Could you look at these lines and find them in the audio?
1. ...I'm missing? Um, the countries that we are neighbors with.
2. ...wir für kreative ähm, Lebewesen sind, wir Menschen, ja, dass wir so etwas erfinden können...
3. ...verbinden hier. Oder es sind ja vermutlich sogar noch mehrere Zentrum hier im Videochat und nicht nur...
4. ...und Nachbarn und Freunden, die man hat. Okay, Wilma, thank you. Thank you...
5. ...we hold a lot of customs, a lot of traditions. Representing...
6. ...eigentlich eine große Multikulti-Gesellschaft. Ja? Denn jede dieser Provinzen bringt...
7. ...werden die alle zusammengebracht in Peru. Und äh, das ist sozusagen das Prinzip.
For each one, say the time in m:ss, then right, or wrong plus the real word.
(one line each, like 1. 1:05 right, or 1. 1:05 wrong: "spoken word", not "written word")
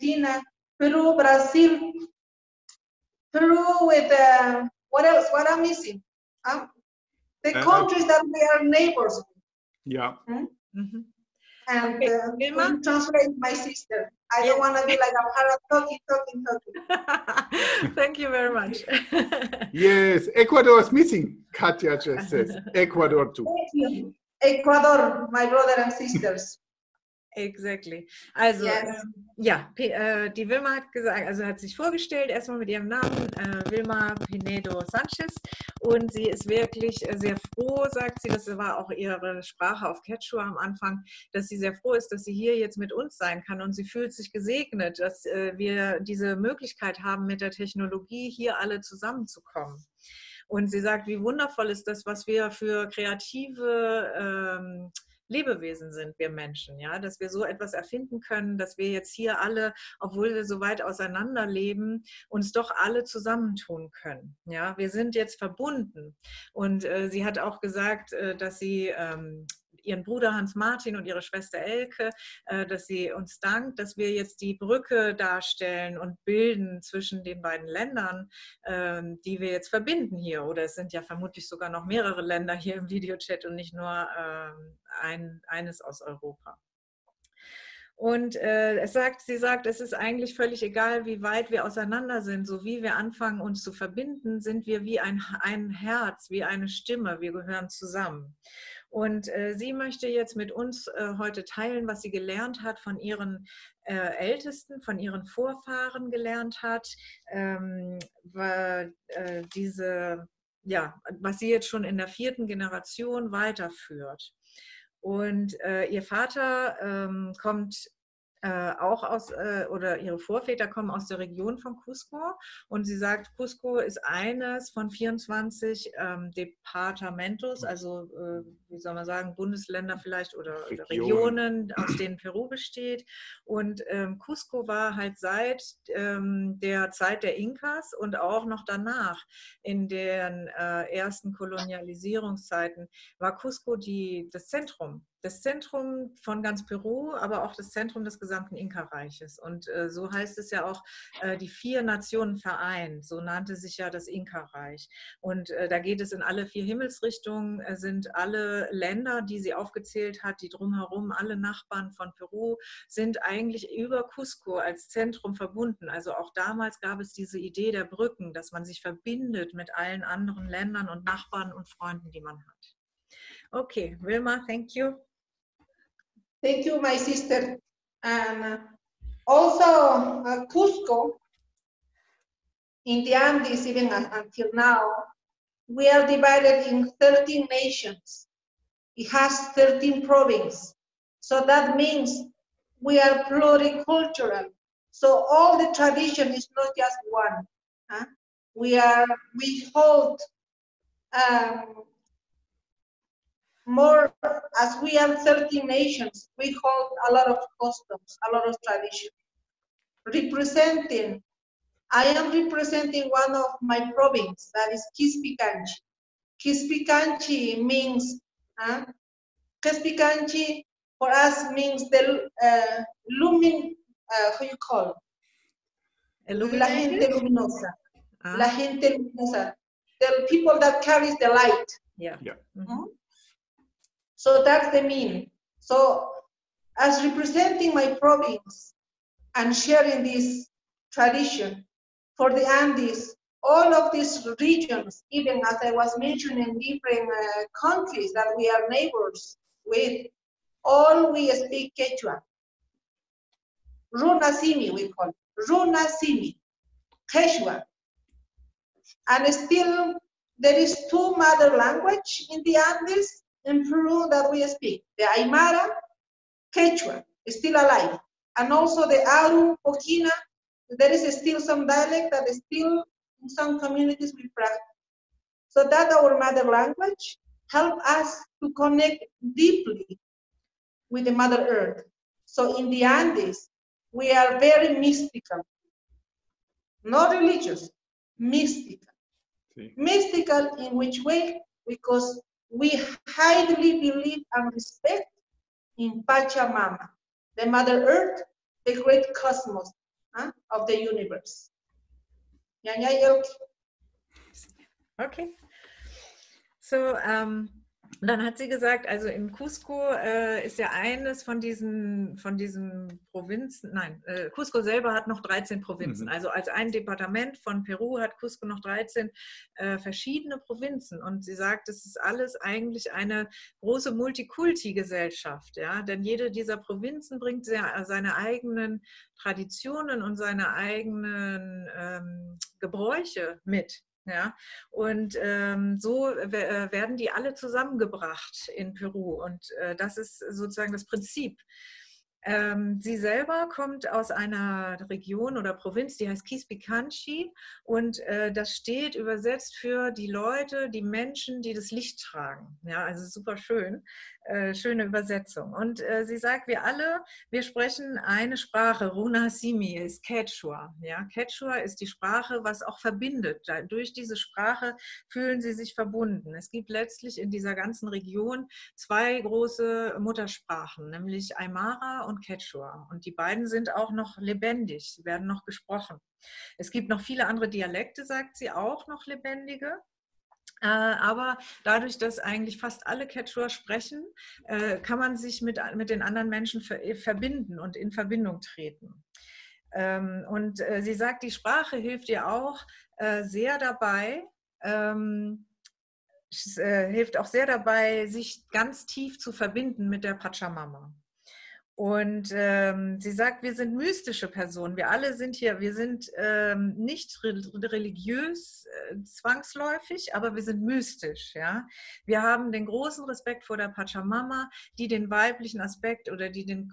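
1. 0:05 right
2. 0:52 right
3. 1:19 wrong: "Länder", not "Zentrum"
4. 2:50 right
5. 3:26 right
6. 5:22 right
7. 5:36 right.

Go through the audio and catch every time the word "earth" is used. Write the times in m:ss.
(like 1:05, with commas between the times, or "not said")
4:41, 4:57.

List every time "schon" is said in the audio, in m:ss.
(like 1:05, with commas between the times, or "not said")
1:51.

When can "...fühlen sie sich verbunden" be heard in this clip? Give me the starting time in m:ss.
6:05.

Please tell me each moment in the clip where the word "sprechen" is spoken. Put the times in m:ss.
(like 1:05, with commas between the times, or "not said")
5:57, 6:23.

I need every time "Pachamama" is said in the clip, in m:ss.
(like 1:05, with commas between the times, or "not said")
4:56, 6:40, 6:53.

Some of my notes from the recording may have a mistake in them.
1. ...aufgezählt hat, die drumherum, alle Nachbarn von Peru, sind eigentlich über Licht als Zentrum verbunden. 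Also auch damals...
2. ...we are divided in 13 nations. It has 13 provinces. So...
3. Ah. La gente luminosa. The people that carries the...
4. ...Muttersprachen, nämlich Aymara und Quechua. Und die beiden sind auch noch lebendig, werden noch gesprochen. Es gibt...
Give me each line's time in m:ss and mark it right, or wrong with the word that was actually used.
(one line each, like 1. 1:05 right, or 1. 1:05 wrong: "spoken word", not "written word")
1. 2:39 wrong: "Cusco", not "Licht"
2. 3:05 right
3. 3:48 right
4. 6:10 right.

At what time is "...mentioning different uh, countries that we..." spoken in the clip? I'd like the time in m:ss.
4:05.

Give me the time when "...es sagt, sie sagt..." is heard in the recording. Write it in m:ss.
1:28.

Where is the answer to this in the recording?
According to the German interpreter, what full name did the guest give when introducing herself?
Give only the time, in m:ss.
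0:33.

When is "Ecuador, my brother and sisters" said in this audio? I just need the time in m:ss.
0:24.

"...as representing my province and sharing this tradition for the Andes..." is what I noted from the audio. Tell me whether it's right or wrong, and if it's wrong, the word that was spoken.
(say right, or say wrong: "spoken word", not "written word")
right.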